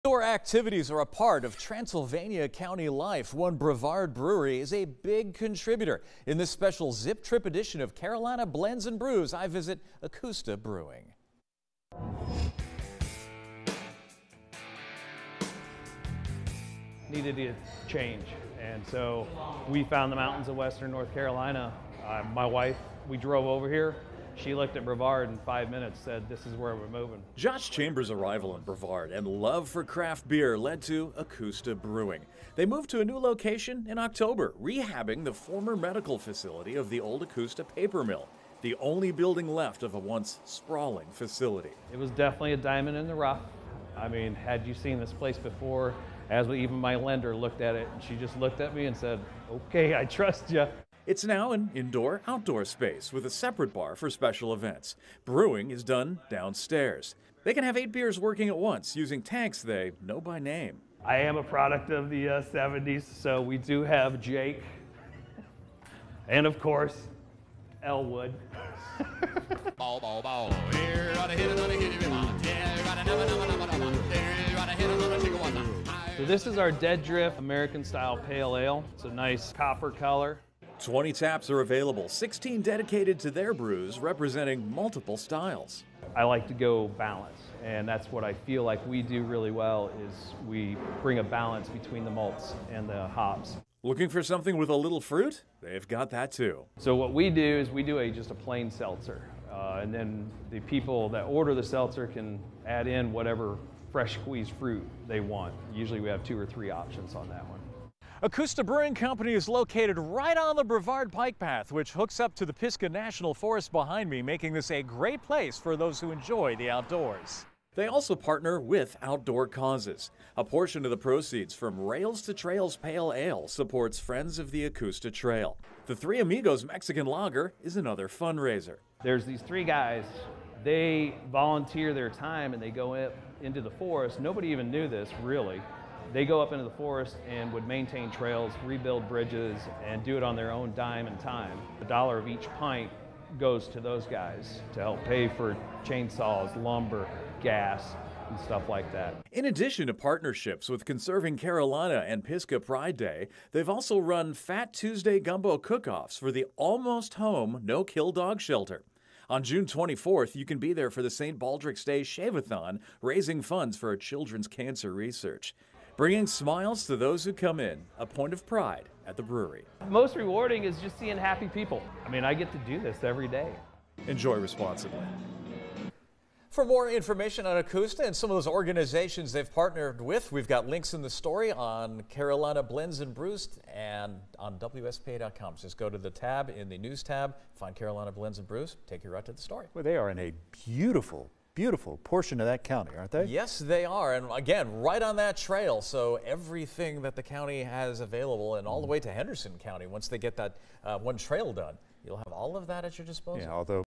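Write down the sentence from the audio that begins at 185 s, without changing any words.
just go to the tab in the news tab, find Carolina Blends and Brews, take you right to the story.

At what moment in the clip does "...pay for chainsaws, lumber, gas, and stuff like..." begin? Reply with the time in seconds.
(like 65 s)
145 s.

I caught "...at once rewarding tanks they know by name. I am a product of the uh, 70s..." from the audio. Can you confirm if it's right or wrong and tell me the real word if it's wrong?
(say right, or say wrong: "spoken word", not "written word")
wrong: "using", not "rewarding".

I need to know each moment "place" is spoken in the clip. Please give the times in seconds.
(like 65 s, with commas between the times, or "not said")
45 s, 115 s.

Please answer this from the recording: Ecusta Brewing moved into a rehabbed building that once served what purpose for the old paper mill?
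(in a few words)
Medical facility.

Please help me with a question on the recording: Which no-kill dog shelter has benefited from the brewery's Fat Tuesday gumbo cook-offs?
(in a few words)
Almost Home.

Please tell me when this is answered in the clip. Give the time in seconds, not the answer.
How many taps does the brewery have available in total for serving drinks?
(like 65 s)
80 s.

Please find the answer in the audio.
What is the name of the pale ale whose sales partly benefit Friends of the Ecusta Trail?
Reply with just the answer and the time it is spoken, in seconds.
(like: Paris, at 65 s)
Rails to Trails Pale Ale, at 121 s.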